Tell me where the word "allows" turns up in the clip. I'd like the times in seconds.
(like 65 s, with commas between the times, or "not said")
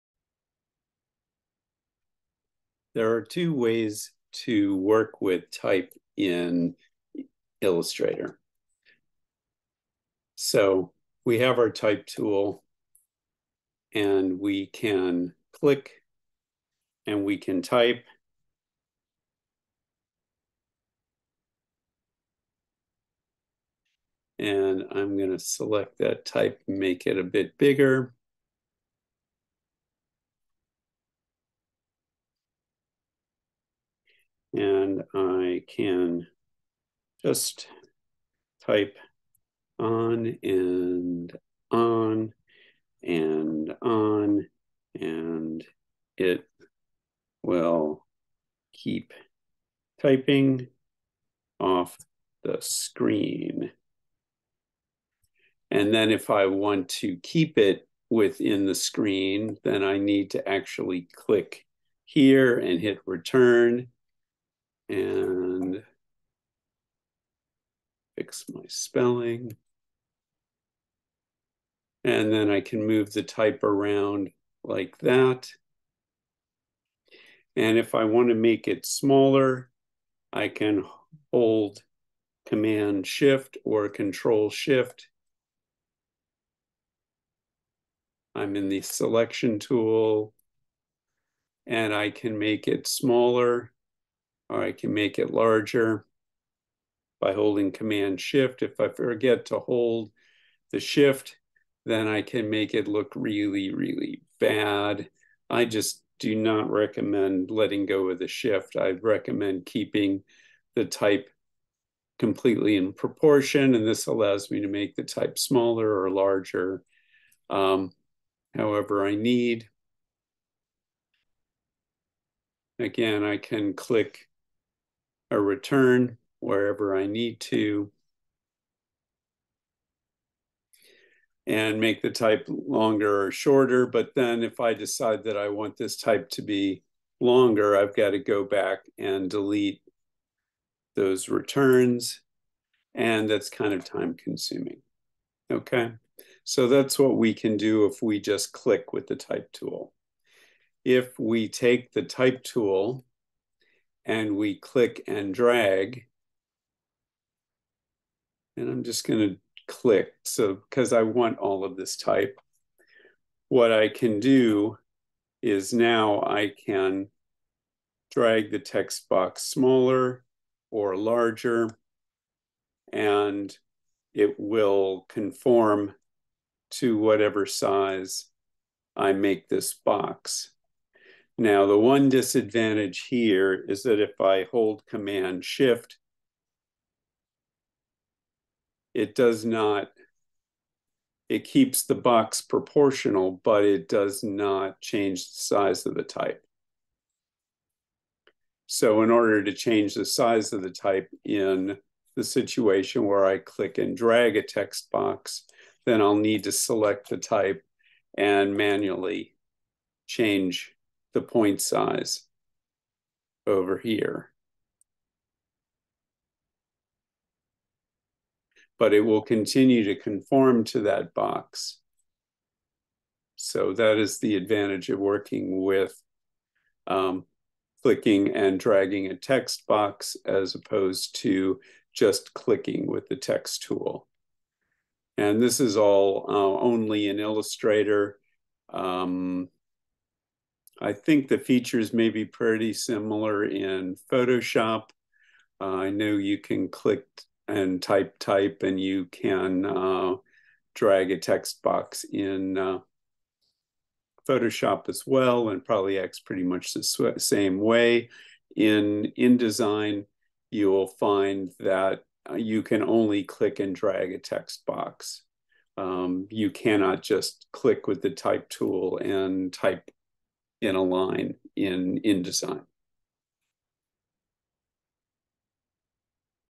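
114 s.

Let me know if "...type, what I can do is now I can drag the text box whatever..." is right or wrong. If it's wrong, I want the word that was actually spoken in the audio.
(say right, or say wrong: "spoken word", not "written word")
wrong: "smaller", not "whatever".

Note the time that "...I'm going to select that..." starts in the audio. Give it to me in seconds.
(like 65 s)
24 s.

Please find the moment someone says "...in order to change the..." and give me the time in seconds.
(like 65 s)
199 s.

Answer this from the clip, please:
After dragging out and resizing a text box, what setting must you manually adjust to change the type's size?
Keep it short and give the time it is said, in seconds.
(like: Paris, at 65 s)
point size, at 208 s.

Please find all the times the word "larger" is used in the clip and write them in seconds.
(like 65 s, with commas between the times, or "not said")
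95 s, 116 s, 170 s.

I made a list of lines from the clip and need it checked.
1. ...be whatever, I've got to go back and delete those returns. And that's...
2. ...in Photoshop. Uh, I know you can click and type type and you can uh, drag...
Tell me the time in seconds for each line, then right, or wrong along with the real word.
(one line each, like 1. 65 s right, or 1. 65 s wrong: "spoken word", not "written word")
1. 136 s wrong: "longer", not "whatever"
2. 243 s right.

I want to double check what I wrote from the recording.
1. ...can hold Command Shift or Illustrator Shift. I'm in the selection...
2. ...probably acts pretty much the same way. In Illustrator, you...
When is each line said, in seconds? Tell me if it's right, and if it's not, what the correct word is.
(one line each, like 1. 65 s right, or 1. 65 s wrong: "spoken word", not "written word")
1. 80 s wrong: "Control", not "Illustrator"
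2. 255 s wrong: "InDesign", not "Illustrator".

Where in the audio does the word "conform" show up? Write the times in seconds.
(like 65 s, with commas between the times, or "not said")
175 s, 219 s.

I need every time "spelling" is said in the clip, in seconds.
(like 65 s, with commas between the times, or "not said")
68 s.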